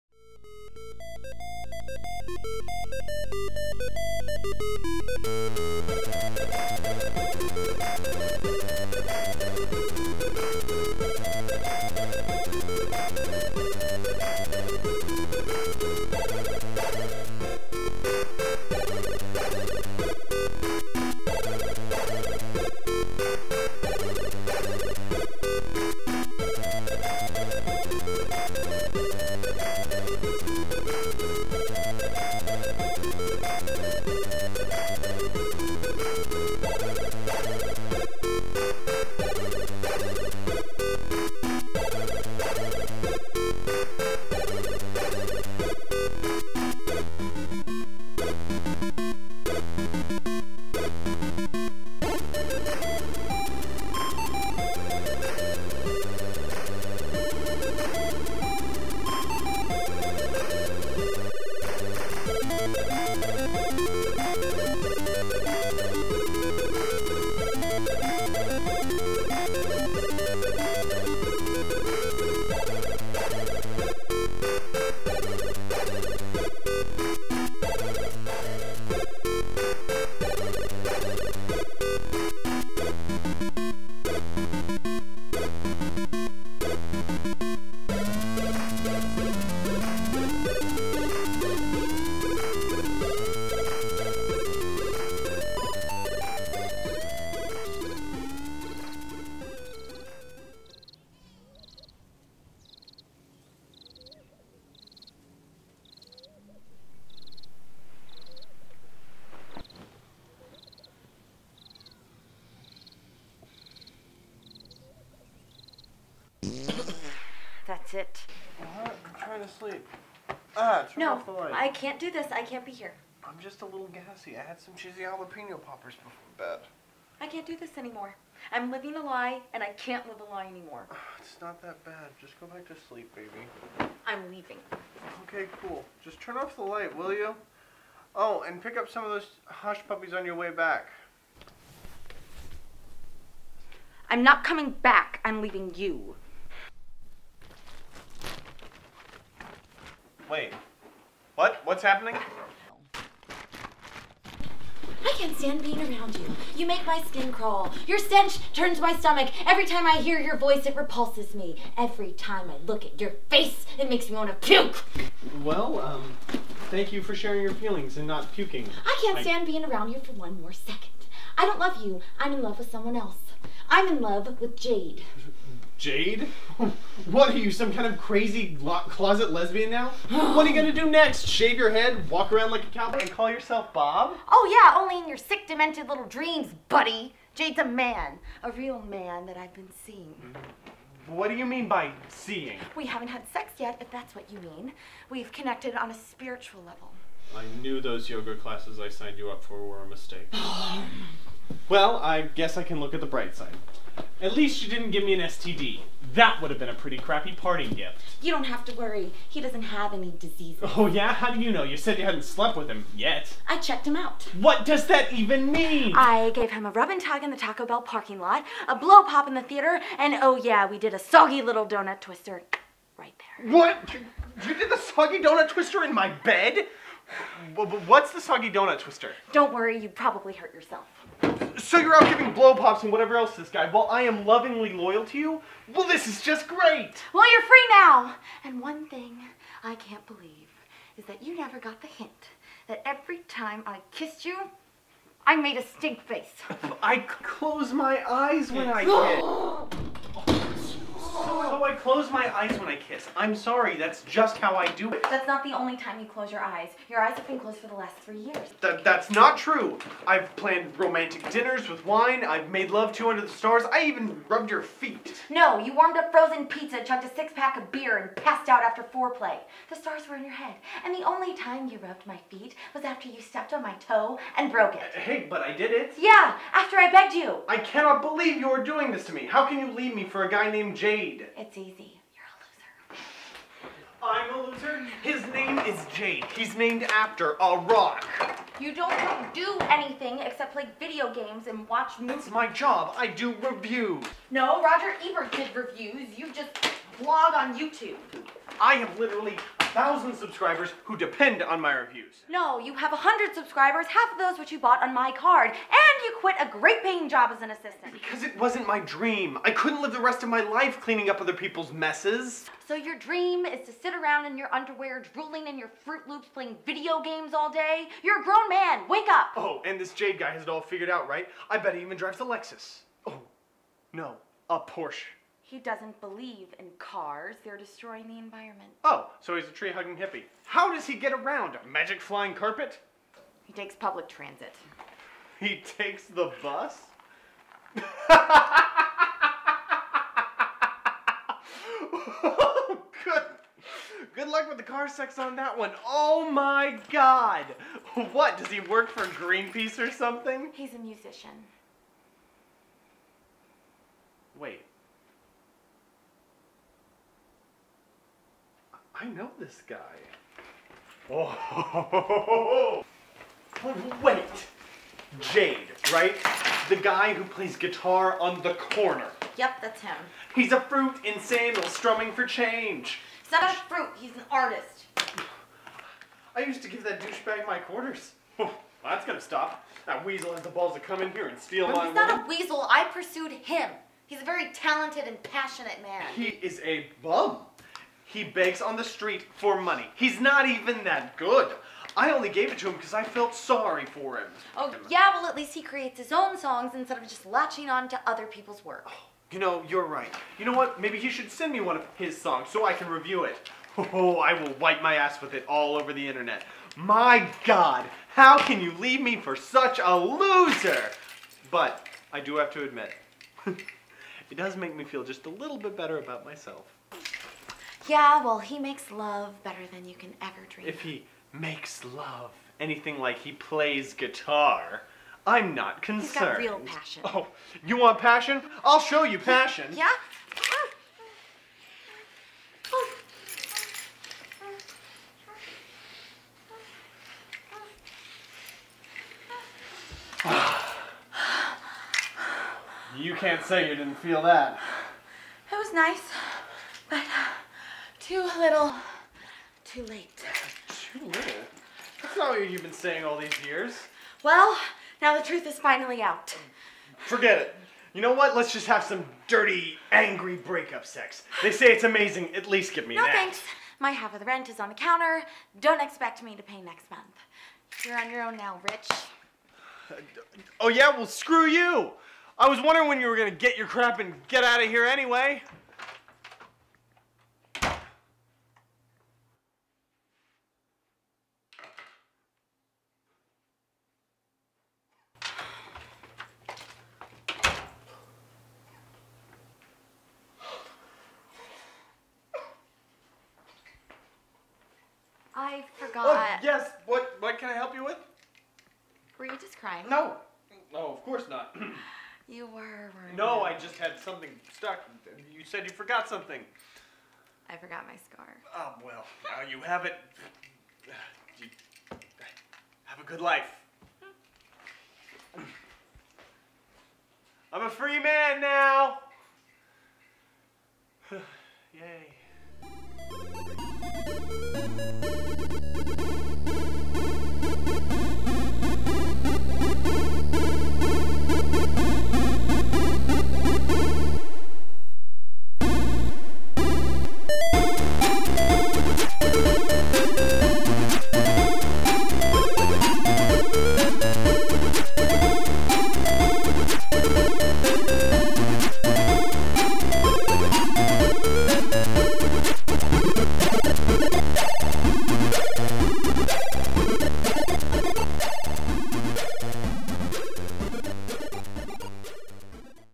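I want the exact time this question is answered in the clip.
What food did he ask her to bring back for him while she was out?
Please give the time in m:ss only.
2:19.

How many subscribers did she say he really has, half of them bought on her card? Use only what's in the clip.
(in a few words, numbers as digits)
100.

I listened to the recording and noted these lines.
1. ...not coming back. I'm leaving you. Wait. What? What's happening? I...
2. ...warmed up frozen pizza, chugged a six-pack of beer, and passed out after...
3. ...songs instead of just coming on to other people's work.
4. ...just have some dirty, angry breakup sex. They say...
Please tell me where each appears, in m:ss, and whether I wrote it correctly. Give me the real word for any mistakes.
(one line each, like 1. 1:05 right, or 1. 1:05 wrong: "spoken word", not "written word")
1. 2:24 right
2. 4:25 right
3. 6:36 wrong: "latching", not "coming"
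4. 7:38 right.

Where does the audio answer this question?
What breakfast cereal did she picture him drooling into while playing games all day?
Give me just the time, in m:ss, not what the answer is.
5:15.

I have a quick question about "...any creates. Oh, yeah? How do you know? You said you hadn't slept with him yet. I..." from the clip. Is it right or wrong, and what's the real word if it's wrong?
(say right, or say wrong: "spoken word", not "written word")
wrong: "diseases", not "creates".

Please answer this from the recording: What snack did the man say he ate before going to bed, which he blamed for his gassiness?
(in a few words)
Cheesy jalapeno poppers.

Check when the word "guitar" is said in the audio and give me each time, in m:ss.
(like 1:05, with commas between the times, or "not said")
6:07, 7:03.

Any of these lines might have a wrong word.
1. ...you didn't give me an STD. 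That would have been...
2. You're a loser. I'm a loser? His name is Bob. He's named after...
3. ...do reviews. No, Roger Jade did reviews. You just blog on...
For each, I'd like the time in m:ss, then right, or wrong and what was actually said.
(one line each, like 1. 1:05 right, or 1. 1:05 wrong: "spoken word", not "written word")
1. 3:24 right
2. 4:42 wrong: "Jade", not "Bob"
3. 4:53 wrong: "Ebert", not "Jade".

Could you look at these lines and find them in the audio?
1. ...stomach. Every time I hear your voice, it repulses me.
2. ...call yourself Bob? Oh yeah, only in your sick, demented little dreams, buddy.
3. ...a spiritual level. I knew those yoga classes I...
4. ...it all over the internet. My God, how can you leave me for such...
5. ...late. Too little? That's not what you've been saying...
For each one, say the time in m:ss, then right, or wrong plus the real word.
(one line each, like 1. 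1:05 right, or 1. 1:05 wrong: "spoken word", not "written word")
1. 2:38 right
2. 3:03 right
3. 3:15 right
4. 6:45 right
5. 7:29 right.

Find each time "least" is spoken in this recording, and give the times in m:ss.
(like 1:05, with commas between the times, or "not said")
3:24, 6:35, 7:42.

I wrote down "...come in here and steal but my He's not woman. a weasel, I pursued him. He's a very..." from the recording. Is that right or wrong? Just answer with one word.
right.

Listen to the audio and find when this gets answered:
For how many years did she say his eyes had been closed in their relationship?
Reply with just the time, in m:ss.
4:17.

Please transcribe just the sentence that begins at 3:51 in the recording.
So you're out giving blow pops and whatever else this guy, while I am lovingly loyal to you?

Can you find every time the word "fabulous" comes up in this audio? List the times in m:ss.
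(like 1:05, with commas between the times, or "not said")
not said.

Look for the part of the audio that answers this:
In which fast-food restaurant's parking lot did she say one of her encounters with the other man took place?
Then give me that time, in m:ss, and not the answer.
3:37.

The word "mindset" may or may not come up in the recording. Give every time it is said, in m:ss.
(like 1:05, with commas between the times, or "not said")
not said.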